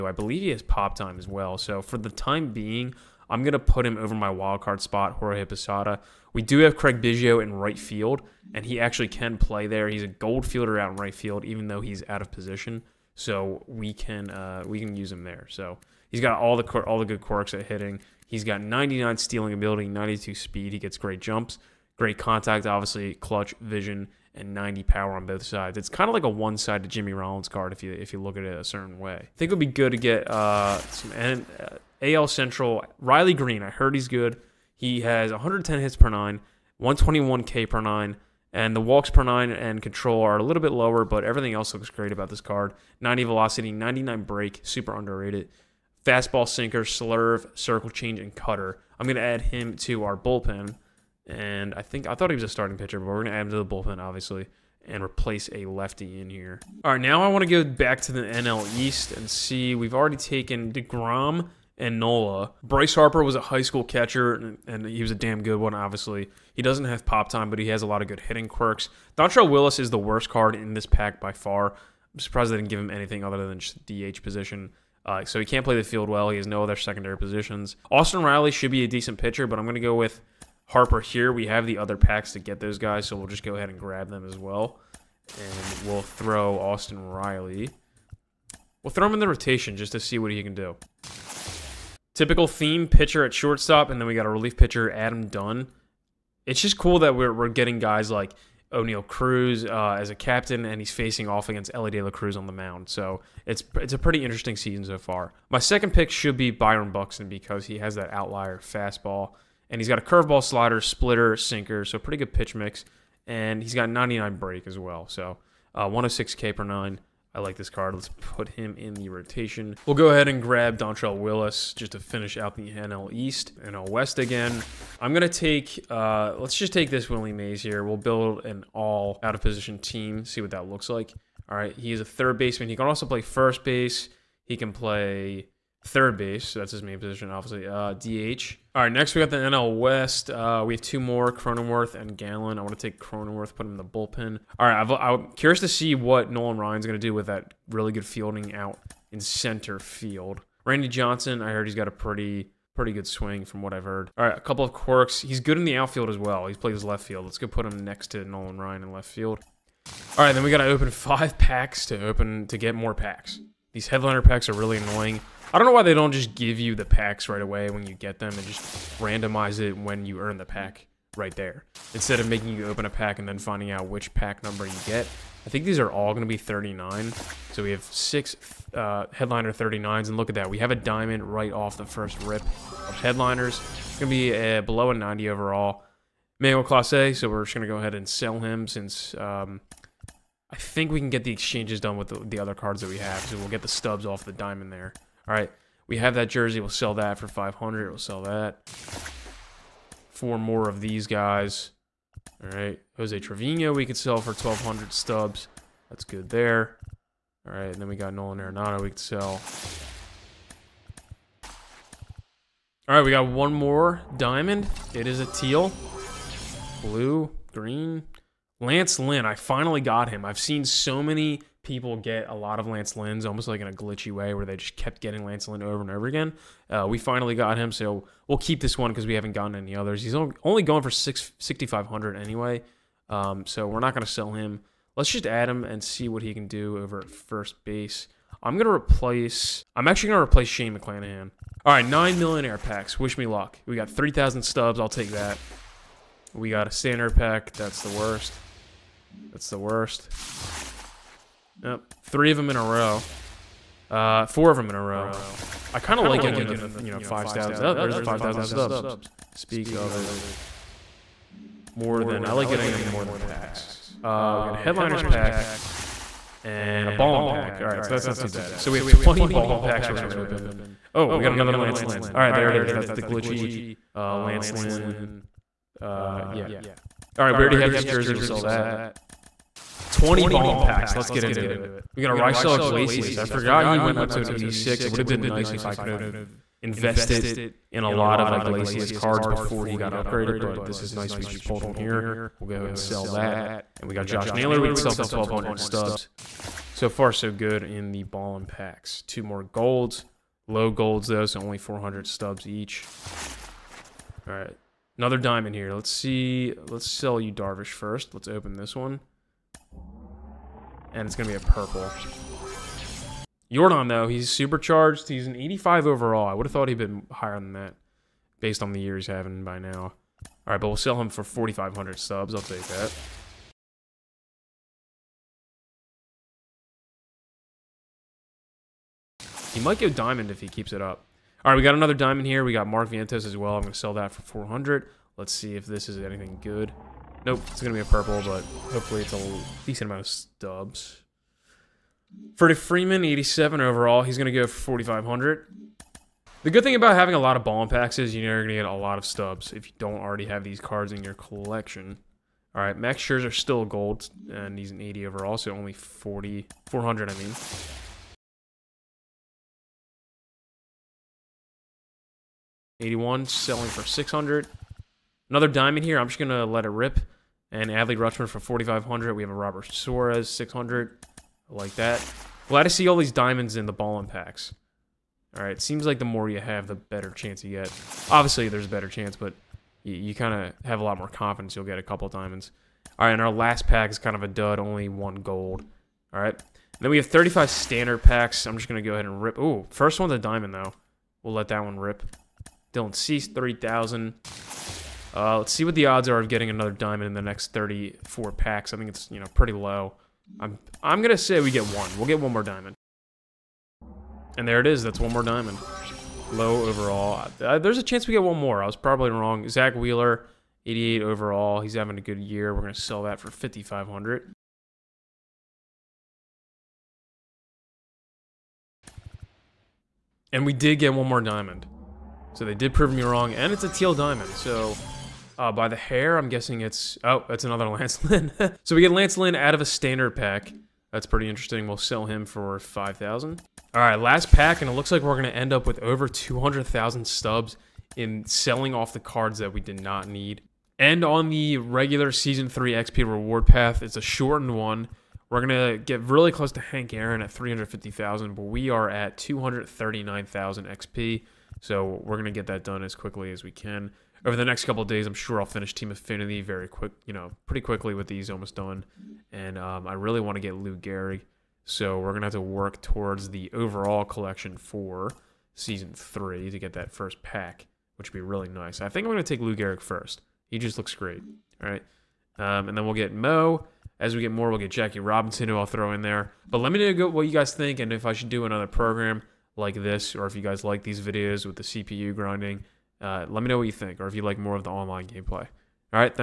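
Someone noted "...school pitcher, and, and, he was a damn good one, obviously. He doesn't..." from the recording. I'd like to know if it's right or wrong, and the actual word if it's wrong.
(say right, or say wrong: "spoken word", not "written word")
wrong: "catcher", not "pitcher".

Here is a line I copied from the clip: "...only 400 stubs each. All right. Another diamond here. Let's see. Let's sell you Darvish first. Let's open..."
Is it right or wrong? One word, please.
right.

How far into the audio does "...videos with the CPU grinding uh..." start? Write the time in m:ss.
8:00.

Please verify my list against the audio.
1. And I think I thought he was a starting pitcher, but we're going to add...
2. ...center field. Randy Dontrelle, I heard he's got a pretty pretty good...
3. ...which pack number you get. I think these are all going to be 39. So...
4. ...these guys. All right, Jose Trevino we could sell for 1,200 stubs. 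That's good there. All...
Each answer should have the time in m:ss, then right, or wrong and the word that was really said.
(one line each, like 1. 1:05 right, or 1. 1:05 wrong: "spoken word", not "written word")
1. 0:51 right
2. 2:29 wrong: "Johnson", not "Dontrelle"
3. 2:53 right
4. 3:20 right.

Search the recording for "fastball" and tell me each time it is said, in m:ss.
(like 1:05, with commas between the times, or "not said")
0:46, 1:48.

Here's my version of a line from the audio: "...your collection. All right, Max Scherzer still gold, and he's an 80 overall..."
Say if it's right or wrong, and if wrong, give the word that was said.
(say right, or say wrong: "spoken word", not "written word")
right.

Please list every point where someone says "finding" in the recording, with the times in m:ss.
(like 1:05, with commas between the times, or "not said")
2:53.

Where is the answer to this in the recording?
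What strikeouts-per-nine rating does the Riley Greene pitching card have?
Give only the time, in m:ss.
0:36.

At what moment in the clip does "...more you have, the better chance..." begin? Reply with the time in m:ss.
6:16.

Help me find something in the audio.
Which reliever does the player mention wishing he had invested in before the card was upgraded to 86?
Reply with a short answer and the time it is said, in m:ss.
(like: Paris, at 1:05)
Raisel Iglesias, at 4:42.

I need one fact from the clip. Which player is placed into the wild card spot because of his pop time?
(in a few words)
Jorge Posada.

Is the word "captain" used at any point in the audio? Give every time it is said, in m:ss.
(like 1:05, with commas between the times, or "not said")
1:40.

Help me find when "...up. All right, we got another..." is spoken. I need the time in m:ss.
5:30.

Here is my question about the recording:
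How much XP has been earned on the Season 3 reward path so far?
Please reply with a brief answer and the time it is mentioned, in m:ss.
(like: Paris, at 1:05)
239,000, at 7:29.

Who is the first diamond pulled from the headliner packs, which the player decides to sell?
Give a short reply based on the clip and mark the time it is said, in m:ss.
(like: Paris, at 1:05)
Manuel Clase, at 3:06.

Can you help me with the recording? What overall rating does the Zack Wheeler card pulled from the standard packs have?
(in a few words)
88.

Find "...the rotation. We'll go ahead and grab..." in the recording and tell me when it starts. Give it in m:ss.
1:58.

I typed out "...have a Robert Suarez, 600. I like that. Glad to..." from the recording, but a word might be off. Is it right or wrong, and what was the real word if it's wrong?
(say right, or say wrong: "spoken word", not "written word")
right.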